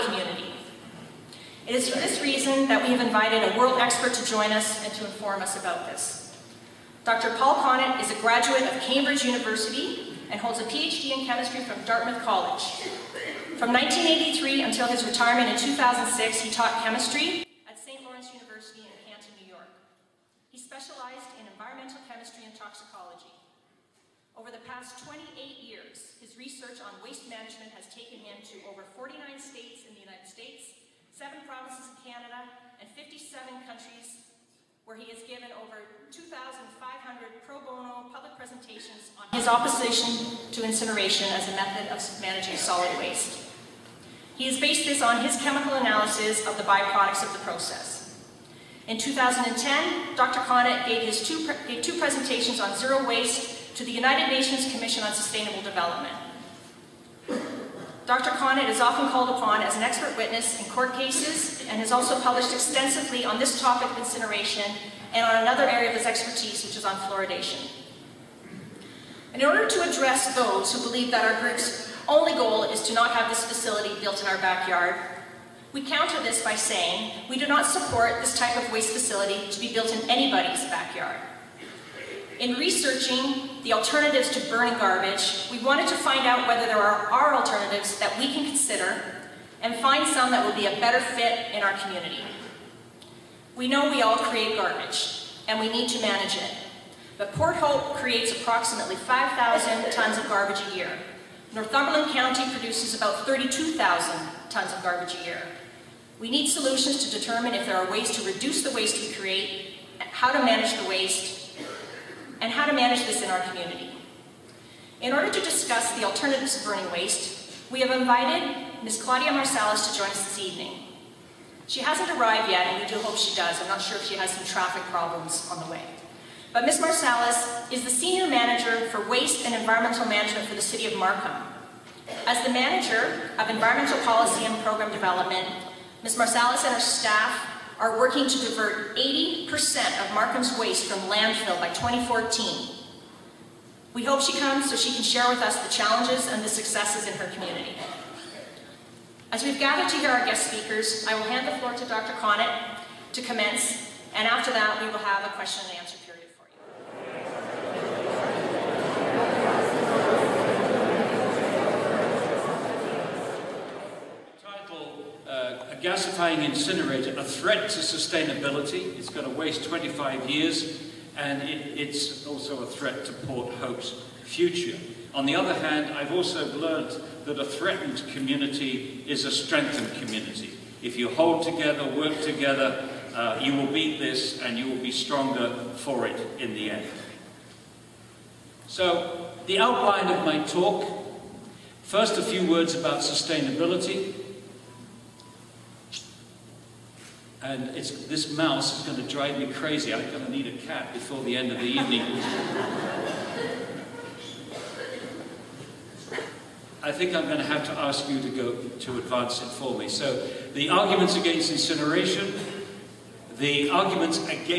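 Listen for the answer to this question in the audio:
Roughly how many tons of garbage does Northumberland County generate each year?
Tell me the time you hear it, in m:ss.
1:43.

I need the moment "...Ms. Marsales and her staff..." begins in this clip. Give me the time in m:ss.
2:16.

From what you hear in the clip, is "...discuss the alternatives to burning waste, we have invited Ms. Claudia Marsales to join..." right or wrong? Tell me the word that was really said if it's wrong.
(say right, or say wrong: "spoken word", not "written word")
right.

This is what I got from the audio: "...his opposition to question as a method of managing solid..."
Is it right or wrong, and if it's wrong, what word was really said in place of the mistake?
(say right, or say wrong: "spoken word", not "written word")
wrong: "incineration", not "question".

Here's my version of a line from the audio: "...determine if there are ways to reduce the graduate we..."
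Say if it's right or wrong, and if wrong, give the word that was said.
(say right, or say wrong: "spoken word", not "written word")
wrong: "waste", not "graduate".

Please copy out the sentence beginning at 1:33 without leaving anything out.
We know we all create garbage, and we need to manage it.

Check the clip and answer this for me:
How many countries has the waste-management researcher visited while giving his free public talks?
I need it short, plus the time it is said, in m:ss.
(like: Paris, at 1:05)
57, at 0:32.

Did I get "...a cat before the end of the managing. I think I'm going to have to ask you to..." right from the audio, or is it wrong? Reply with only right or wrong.
wrong.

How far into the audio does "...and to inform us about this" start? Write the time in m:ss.
0:04.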